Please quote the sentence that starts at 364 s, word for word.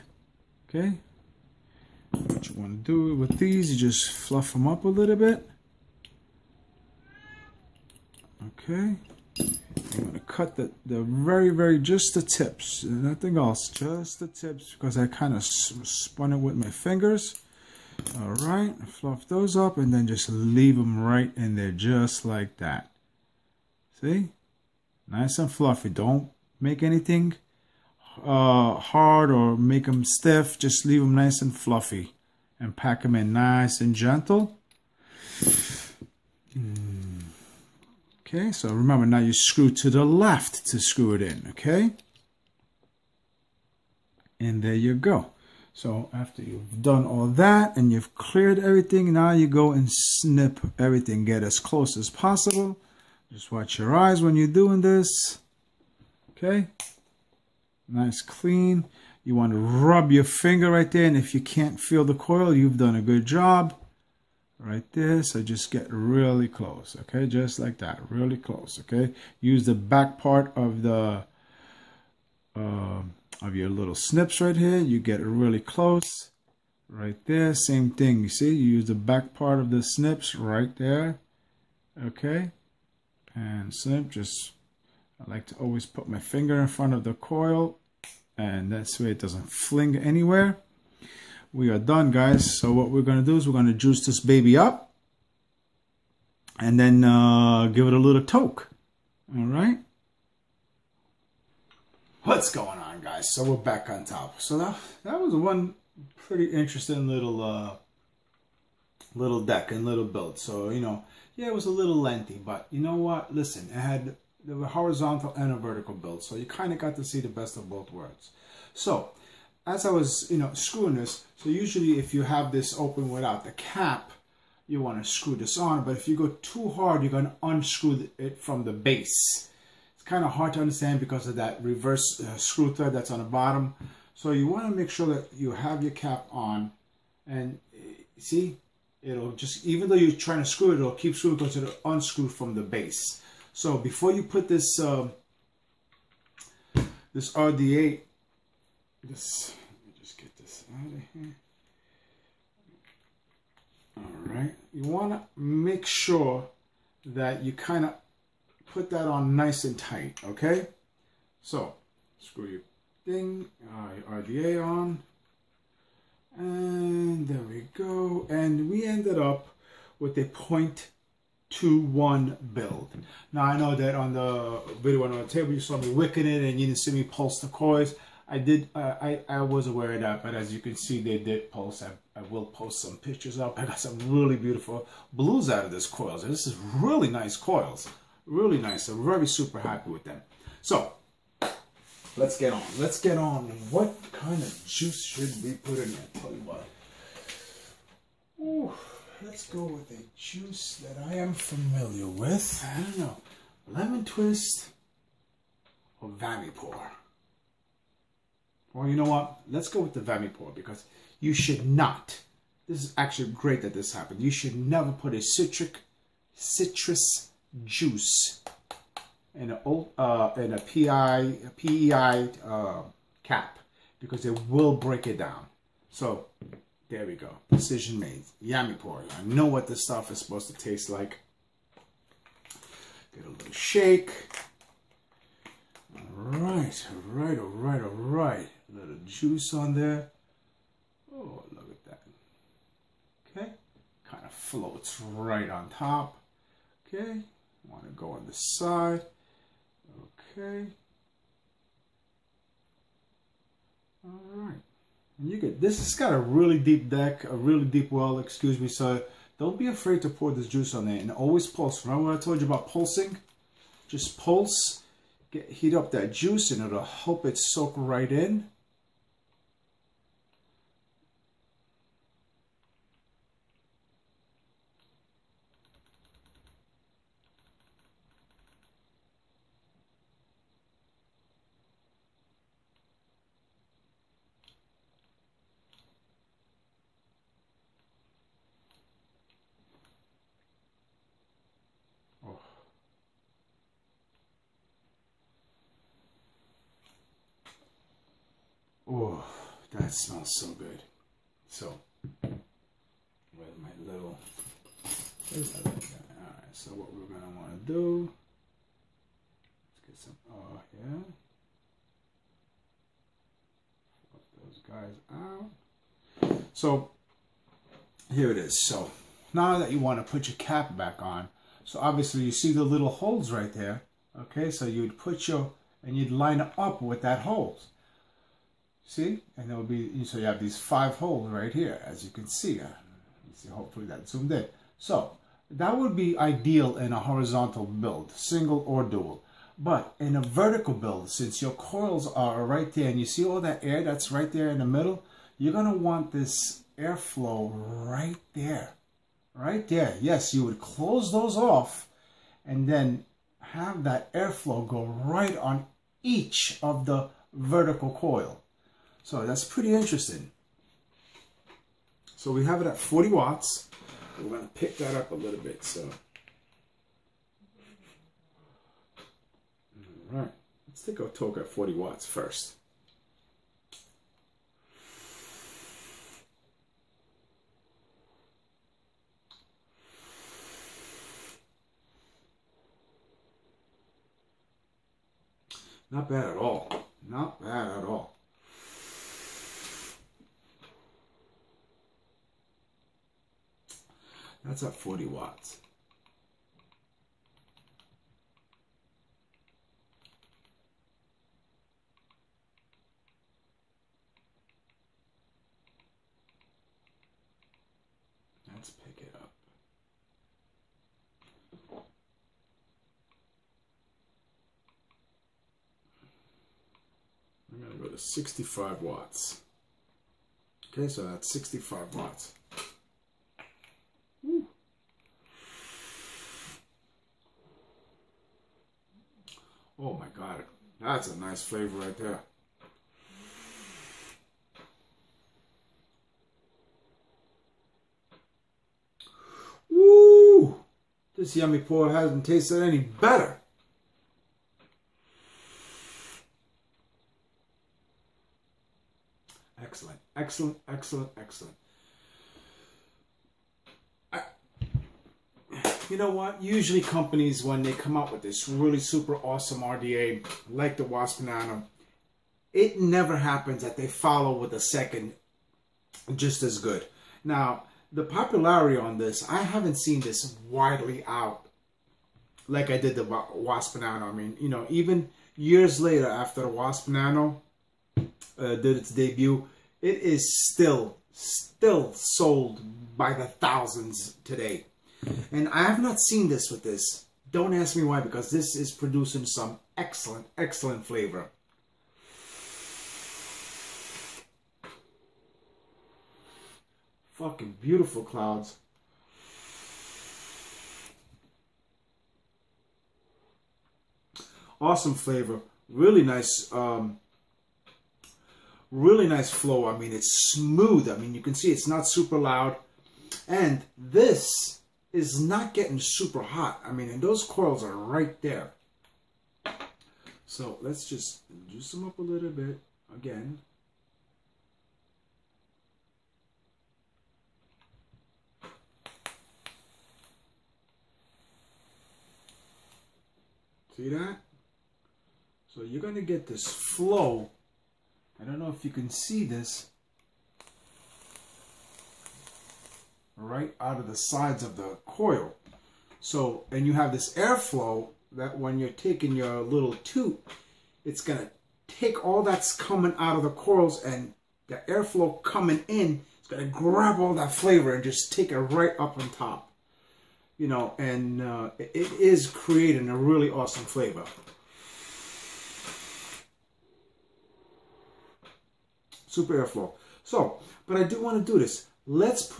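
We're going to pick that up a little bit.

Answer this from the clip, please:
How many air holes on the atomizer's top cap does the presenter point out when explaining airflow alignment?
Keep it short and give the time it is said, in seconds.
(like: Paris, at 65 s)
5, at 330 s.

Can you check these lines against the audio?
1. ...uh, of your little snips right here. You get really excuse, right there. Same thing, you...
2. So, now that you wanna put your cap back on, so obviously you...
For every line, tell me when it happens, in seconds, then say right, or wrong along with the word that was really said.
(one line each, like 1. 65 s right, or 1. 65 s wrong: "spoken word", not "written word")
1. 72 s wrong: "close", not "excuse"
2. 318 s right.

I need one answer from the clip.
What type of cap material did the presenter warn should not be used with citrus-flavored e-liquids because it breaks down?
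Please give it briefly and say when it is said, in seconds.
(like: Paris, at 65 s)
PEI, at 221 s.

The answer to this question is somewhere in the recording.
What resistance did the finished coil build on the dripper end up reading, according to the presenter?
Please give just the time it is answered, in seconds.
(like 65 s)
170 s.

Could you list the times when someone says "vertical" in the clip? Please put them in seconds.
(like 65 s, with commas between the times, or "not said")
115 s, 340 s, 357 s.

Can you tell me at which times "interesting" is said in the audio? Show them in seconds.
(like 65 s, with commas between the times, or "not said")
106 s, 359 s.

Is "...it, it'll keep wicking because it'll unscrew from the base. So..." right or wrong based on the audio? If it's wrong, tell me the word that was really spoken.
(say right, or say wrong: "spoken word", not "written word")
wrong: "screwing", not "wicking".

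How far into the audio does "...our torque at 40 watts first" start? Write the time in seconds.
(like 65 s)
370 s.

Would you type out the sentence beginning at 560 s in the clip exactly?
You know, and uh, it is creating a really awesome flavor.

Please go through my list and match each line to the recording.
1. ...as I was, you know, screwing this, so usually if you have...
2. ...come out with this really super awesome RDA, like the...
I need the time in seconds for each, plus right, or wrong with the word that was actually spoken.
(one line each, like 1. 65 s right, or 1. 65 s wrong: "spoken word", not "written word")
1. 119 s right
2. 457 s right.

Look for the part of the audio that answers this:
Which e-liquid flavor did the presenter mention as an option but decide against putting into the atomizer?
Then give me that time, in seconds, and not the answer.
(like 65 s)
203 s.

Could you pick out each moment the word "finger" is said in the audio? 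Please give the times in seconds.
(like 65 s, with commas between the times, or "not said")
16 s, 60 s, 86 s.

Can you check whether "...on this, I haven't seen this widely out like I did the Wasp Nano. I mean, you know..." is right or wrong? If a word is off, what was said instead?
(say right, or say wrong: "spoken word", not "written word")
right.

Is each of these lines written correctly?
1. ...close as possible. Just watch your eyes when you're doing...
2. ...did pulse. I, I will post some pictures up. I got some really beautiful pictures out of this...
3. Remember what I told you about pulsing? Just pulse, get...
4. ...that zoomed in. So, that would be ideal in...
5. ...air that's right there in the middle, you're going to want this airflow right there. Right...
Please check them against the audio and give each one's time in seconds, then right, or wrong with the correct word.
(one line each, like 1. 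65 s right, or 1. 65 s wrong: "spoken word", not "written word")
1. 51 s right
2. 181 s wrong: "blues", not "pictures"
3. 261 s right
4. 333 s right
5. 343 s right.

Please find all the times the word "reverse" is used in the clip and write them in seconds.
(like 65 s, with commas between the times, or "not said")
131 s.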